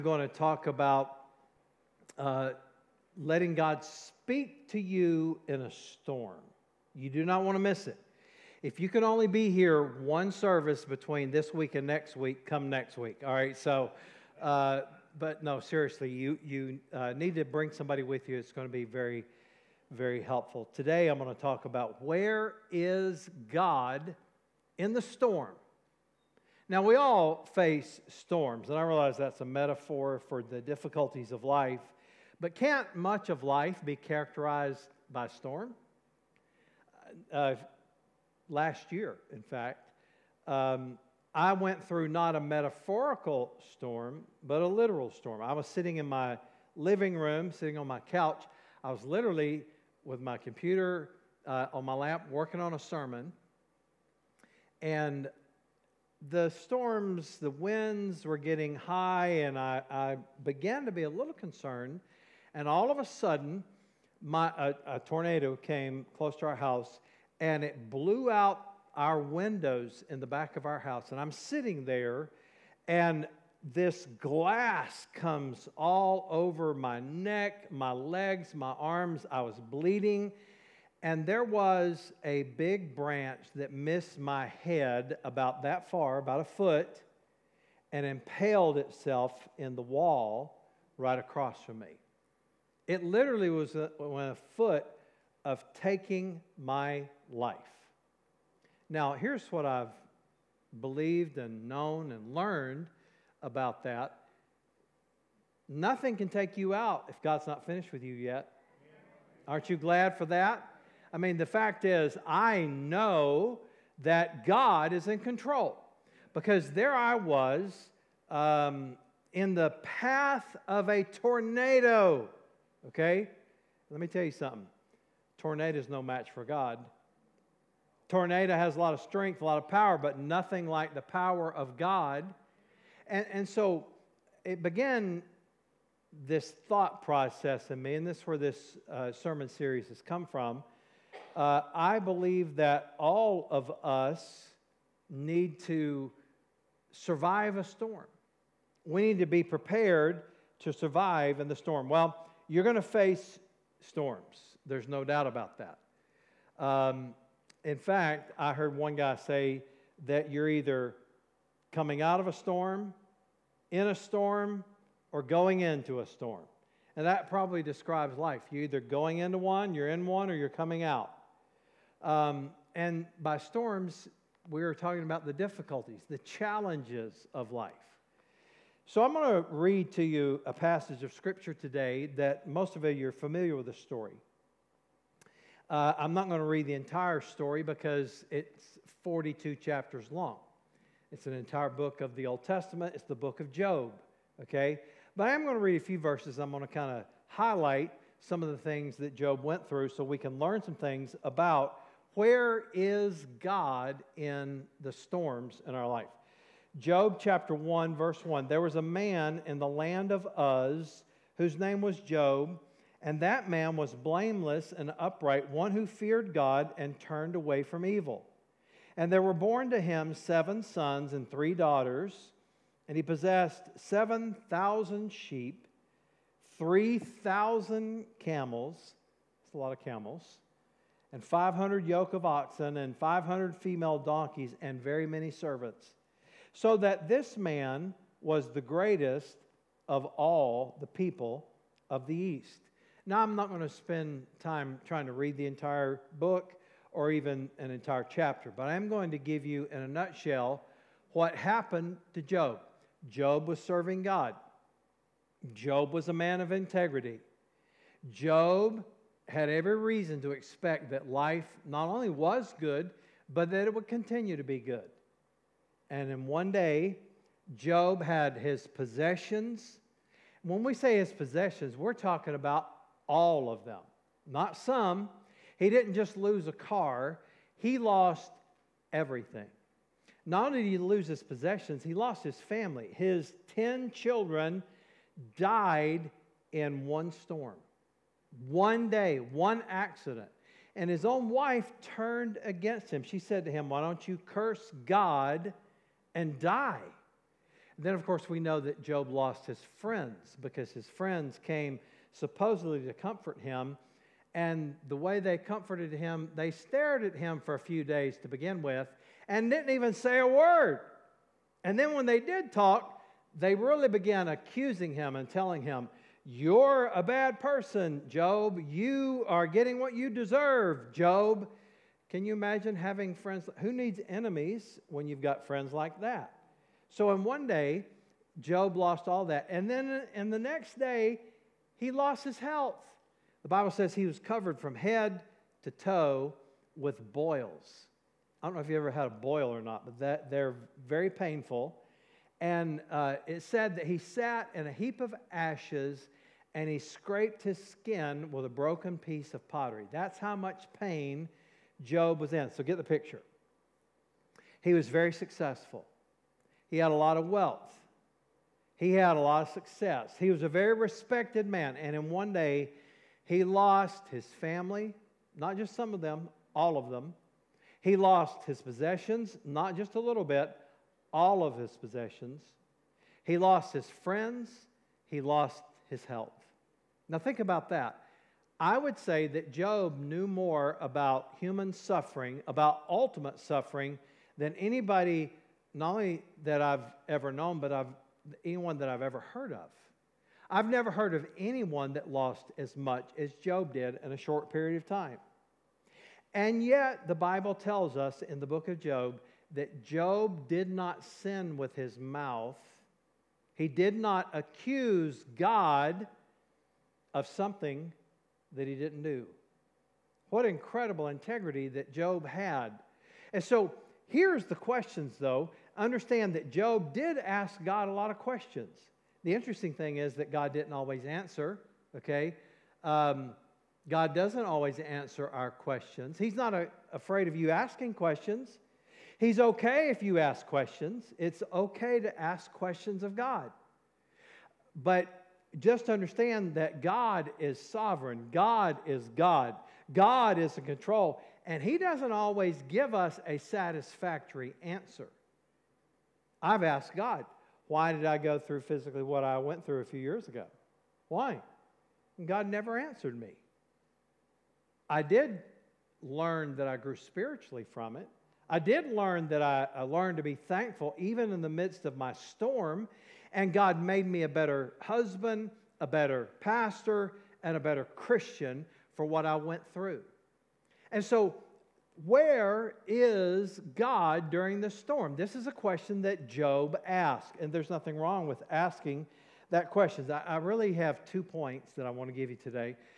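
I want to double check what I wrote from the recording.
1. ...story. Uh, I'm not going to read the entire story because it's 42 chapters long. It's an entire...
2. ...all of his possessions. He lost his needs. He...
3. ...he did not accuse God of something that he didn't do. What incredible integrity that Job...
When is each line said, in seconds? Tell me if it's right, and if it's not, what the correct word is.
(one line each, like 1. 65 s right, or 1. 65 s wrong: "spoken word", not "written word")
1. 183 s right
2. 371 s wrong: "friends", not "needs"
3. 403 s right.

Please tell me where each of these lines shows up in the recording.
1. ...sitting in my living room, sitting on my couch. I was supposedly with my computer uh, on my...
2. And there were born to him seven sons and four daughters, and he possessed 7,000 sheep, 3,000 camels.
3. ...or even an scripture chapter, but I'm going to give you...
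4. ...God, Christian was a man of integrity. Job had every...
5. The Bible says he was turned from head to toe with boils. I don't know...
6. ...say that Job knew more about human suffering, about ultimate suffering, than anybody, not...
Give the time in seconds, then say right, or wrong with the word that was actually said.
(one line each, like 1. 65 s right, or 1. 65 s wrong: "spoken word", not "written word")
1. 45 s wrong: "literally", not "supposedly"
2. 218 s wrong: "three", not "four"
3. 246 s wrong: "entire", not "scripture"
4. 254 s wrong: "Job", not "Christian"
5. 333 s wrong: "covered", not "turned"
6. 378 s right.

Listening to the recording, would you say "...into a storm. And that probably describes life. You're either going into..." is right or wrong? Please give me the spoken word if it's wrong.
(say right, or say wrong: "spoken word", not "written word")
right.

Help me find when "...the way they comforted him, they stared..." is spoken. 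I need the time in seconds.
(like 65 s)
304 s.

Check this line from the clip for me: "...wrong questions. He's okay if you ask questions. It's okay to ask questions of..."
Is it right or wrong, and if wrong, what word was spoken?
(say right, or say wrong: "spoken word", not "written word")
wrong: "asking", not "wrong".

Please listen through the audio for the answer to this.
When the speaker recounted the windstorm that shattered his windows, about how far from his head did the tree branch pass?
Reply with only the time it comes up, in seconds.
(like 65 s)
86 s.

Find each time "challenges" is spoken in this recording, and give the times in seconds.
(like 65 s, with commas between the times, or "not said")
176 s.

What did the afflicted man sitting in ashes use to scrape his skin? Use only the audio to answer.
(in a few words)
a broken piece of pottery.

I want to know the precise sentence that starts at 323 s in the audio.
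Who needs enemies when you've got friends like that?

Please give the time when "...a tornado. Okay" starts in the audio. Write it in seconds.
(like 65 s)
120 s.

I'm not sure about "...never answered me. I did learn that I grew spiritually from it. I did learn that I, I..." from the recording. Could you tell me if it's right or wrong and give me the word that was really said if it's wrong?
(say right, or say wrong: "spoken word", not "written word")
right.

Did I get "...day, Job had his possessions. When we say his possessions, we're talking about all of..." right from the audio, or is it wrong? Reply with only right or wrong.
right.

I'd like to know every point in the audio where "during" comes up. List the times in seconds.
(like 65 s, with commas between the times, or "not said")
474 s.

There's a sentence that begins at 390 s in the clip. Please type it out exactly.
I've never heard of anyone that lost as much as Job did in a short period of time.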